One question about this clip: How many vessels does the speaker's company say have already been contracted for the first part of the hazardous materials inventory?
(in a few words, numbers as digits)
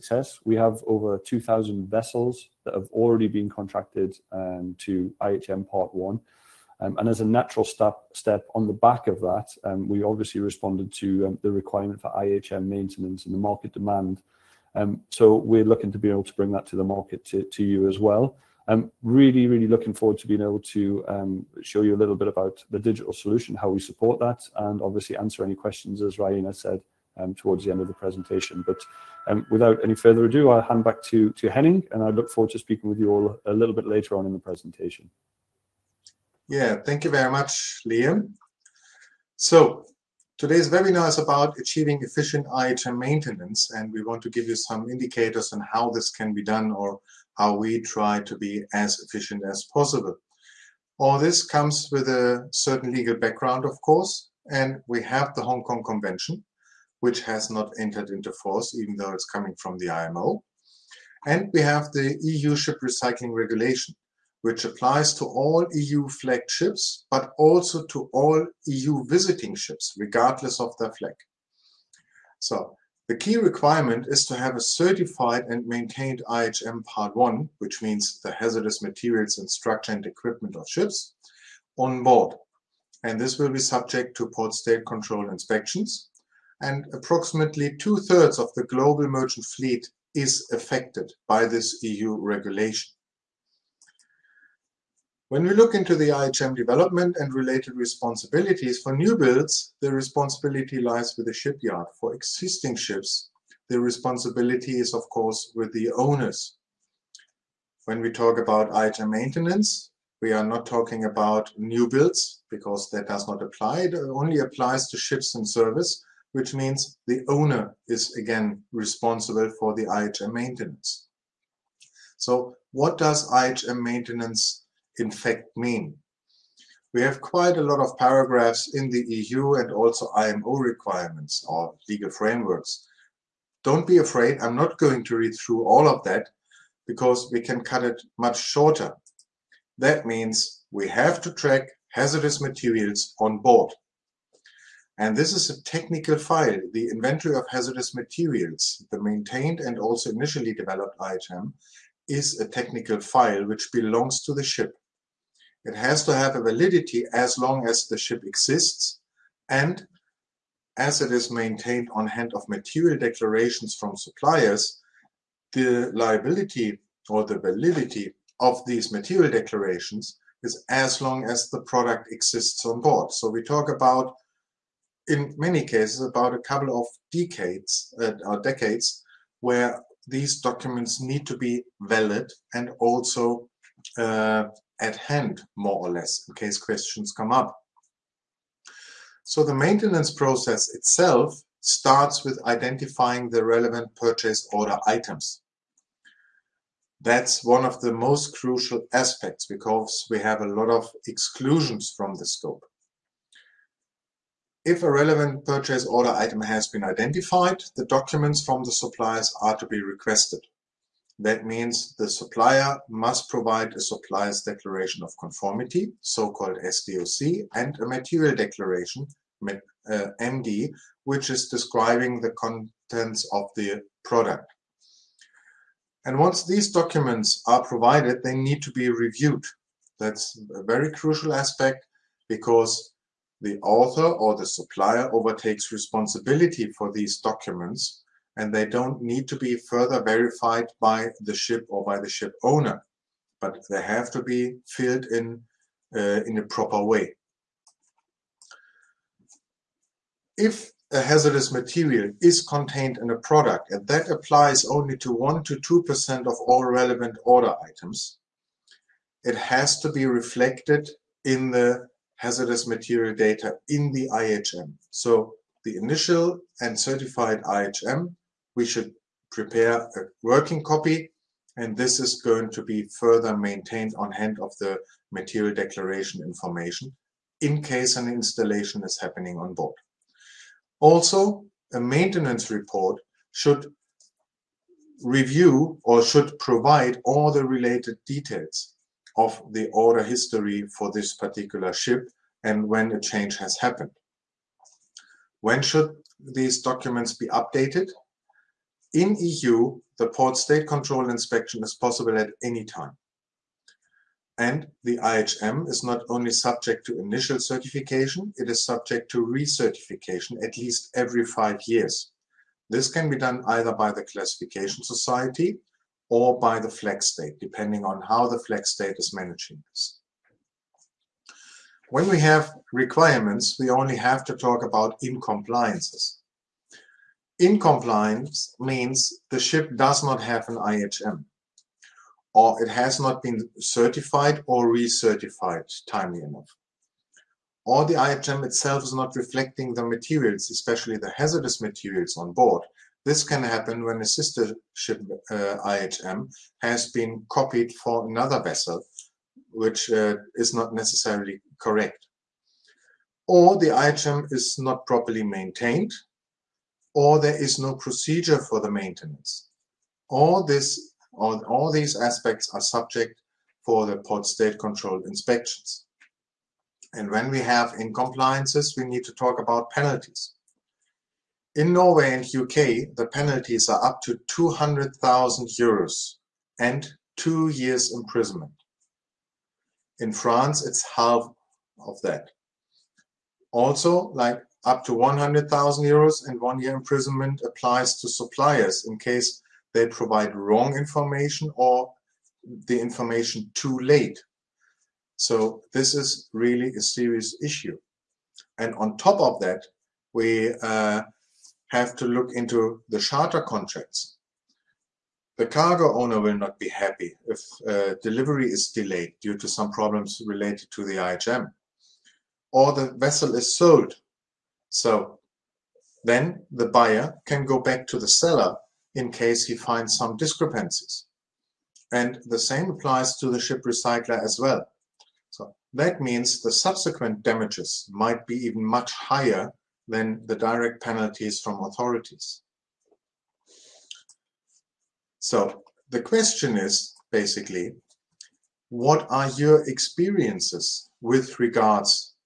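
over 2,000.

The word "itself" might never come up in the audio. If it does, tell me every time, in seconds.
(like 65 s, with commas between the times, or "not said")
190 s, 338 s.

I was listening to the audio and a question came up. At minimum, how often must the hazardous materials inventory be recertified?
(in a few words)
every five years.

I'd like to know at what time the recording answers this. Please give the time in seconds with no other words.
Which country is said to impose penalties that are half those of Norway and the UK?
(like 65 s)
380 s.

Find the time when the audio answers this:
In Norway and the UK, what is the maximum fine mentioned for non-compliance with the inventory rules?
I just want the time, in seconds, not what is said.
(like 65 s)
374 s.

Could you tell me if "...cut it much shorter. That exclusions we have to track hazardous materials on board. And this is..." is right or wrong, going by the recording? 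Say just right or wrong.
wrong.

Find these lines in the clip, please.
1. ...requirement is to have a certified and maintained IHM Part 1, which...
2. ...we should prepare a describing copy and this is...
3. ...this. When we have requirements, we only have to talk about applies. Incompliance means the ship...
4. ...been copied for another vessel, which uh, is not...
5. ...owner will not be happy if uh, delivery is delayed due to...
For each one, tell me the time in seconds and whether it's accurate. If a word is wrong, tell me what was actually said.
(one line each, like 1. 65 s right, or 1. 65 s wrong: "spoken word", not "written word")
1. 73 s right
2. 268 s wrong: "working", not "describing"
3. 319 s wrong: "incompliances", not "applies"
4. 346 s right
5. 405 s right.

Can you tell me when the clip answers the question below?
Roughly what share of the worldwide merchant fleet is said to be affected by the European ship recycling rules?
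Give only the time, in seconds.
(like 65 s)
87 s.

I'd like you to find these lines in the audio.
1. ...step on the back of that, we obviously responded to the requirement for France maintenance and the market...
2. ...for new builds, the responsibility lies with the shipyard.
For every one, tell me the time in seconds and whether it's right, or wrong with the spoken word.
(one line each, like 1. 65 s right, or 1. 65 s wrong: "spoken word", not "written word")
1. 8 s wrong: "IHM", not "France"
2. 98 s right.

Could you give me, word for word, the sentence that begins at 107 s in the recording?
When we talk about IHM maintenance, we are not talking about new builds because that does not apply.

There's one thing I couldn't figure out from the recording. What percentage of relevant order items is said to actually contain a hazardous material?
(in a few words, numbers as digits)
1 to 2%.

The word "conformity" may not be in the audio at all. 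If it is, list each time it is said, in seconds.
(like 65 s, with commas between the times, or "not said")
215 s.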